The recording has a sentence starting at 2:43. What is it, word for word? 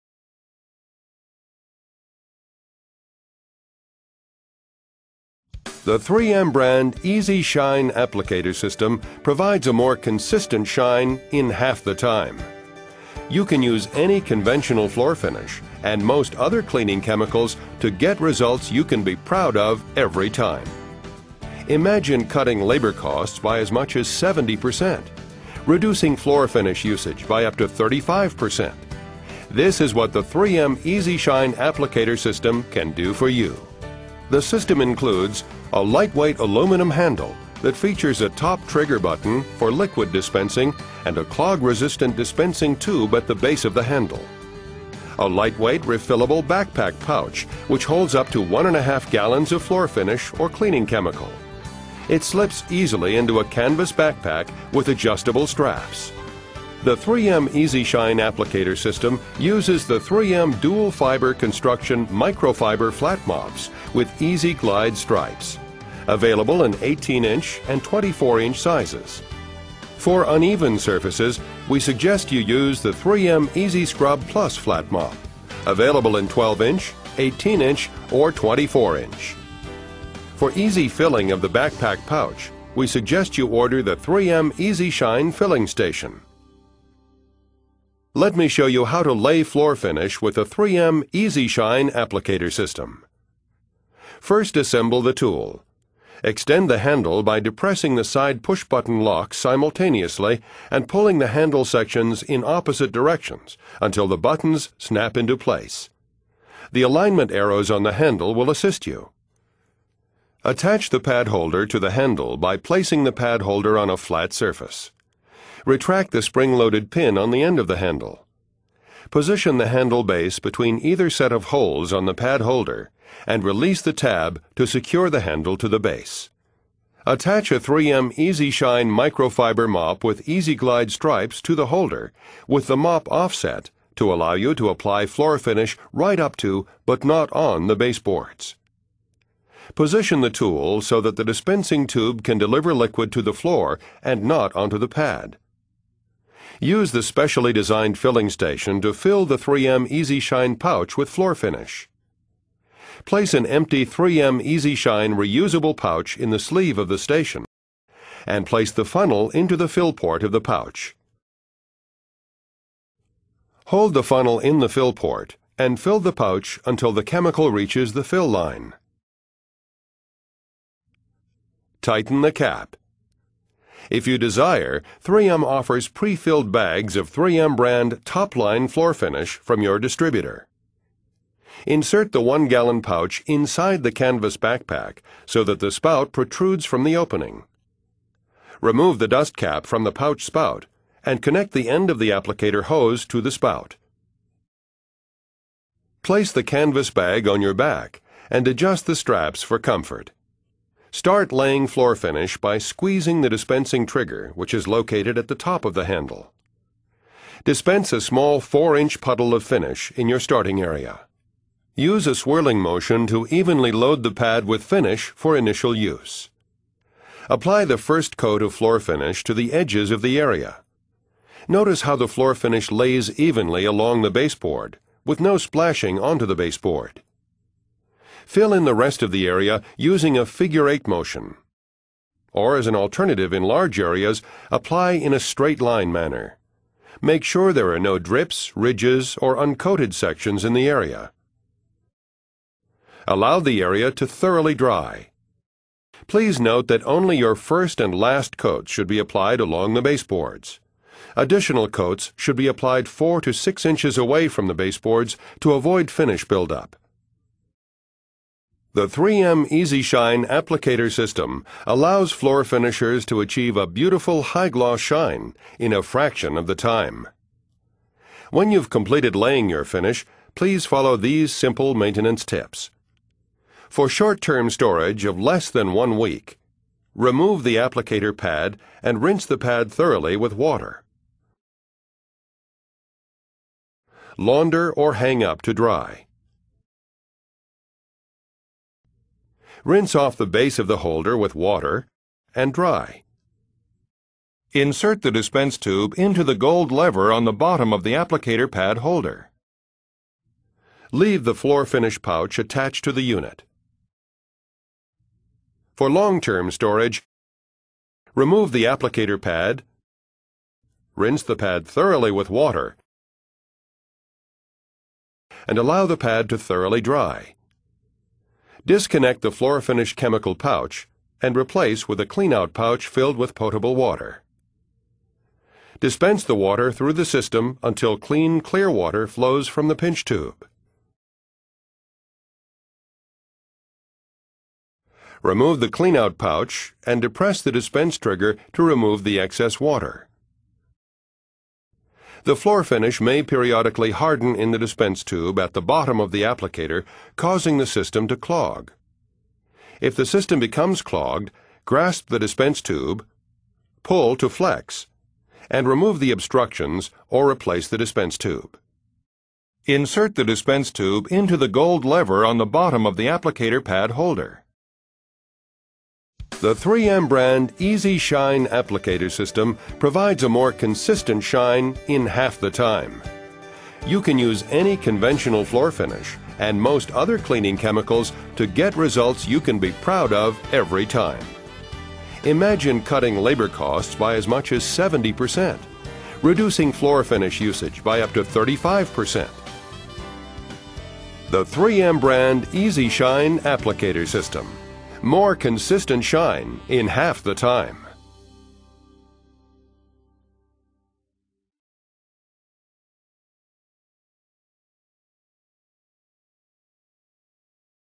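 Hold the funnel in the fill port and fill the pouch until the chemical reaches the fill line.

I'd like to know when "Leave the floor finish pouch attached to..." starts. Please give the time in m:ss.
5:00.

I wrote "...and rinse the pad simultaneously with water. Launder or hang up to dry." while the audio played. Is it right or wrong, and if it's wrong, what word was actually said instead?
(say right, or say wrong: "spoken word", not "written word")
wrong: "thoroughly", not "simultaneously".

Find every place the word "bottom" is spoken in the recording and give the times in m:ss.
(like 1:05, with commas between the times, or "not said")
4:57, 5:45, 6:02.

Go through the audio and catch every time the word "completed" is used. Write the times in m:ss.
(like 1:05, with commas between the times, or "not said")
4:28.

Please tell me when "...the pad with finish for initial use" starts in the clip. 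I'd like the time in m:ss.
3:34.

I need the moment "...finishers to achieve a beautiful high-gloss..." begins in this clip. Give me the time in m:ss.
4:22.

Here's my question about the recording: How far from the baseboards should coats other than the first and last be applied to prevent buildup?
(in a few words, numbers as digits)
4 to 6 inches.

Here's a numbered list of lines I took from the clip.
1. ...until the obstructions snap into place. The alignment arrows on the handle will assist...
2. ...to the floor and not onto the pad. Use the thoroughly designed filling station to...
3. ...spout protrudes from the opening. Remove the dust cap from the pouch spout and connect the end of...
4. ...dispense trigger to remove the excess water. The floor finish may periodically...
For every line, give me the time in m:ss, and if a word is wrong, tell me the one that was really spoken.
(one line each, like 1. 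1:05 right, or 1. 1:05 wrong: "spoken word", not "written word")
1. 1:43 wrong: "buttons", not "obstructions"
2. 2:23 wrong: "specially", not "thoroughly"
3. 3:05 right
4. 5:37 right.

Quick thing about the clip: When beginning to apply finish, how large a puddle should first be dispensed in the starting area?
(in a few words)
4-inch.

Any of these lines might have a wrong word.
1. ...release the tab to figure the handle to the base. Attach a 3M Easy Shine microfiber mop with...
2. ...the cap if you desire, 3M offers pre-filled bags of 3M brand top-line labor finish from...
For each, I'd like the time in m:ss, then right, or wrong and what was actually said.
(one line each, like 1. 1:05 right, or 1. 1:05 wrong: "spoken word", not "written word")
1. 2:03 wrong: "secure", not "figure"
2. 2:52 wrong: "floor", not "labor".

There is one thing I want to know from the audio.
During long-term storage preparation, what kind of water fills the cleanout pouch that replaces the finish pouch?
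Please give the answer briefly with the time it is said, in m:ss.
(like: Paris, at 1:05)
potable water, at 5:23.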